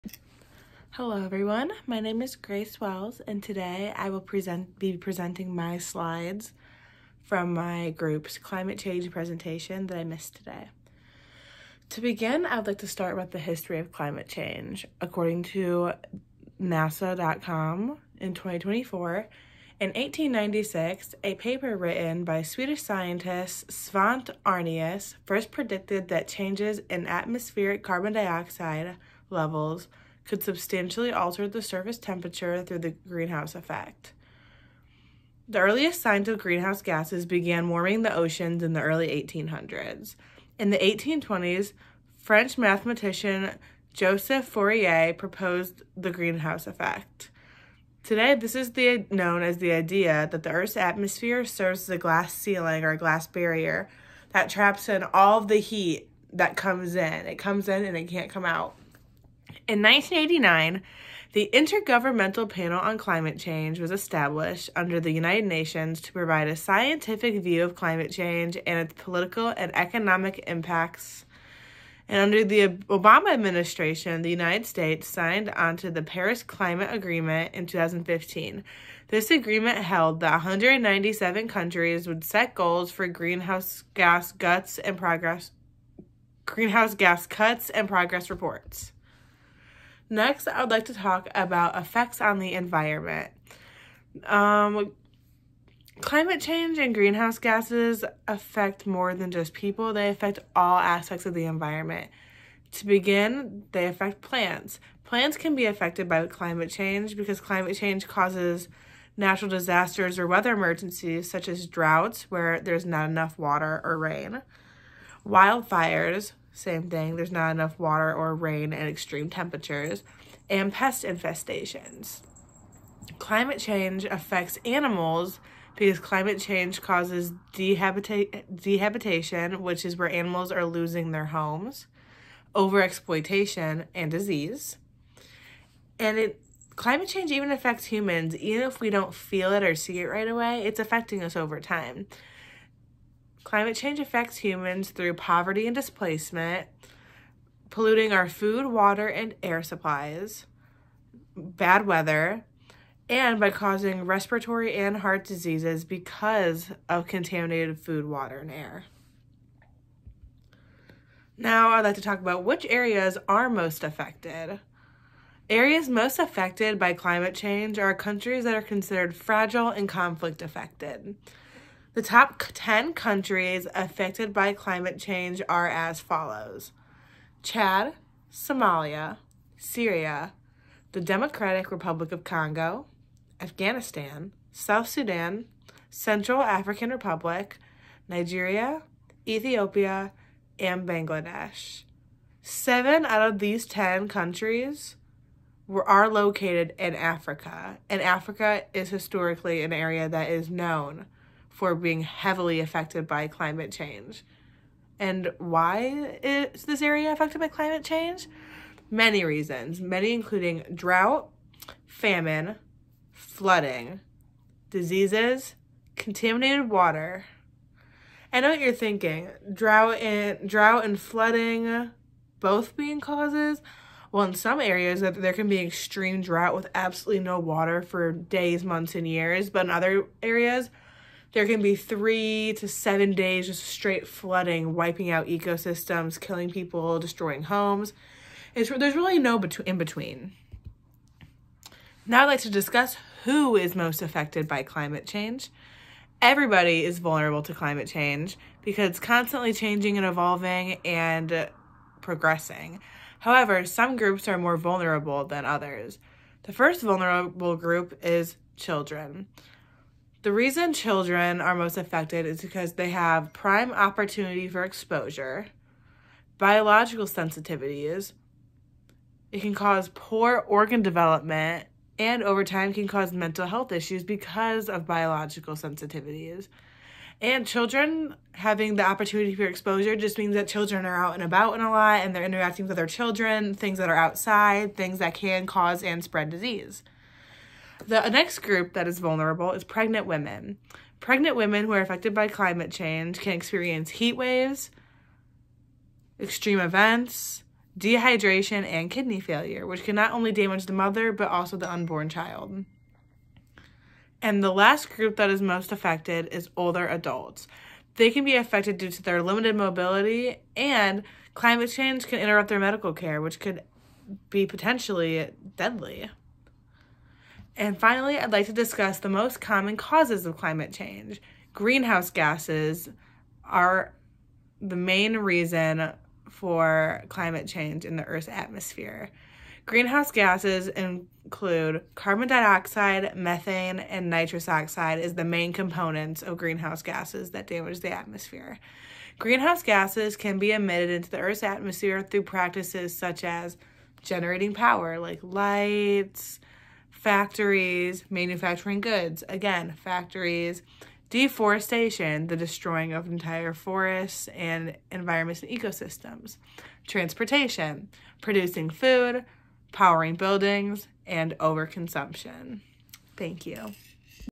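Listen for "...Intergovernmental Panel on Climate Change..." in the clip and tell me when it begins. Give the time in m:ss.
1:01.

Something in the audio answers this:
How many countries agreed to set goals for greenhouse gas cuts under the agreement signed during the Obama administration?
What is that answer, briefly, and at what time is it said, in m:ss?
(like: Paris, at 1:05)
197, at 1:20.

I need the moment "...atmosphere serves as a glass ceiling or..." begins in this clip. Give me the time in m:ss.
0:50.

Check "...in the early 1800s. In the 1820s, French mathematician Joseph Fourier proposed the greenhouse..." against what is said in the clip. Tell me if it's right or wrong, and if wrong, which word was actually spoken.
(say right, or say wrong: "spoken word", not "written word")
right.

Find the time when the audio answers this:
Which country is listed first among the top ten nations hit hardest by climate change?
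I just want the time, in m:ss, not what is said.
2:57.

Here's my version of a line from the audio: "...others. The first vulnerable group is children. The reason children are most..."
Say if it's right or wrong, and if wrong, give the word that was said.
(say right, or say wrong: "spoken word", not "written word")
right.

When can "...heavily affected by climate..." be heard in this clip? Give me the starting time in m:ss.
3:22.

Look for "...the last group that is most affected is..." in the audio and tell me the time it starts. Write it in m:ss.
5:04.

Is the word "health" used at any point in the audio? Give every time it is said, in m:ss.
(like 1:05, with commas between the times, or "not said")
4:33.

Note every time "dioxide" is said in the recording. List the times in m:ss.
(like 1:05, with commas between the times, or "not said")
0:28, 5:32.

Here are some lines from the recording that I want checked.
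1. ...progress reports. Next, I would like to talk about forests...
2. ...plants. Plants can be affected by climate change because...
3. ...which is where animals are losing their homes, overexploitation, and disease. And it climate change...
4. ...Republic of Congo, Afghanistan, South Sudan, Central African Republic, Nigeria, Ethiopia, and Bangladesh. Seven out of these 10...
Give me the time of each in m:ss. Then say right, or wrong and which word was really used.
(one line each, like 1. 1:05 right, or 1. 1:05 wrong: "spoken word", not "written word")
1. 1:27 wrong: "effects", not "forests"
2. 1:44 right
3. 2:09 right
4. 3:01 right.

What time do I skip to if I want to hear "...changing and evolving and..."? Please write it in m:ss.
4:09.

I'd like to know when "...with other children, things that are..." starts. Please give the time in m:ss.
4:42.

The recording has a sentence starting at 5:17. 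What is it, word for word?
And finally, I'd like to discuss the most common causes of climate change.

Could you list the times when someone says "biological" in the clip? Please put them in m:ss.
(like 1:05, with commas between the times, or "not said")
4:26, 4:34.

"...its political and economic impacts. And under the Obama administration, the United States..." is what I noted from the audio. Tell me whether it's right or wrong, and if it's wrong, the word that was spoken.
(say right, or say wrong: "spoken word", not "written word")
right.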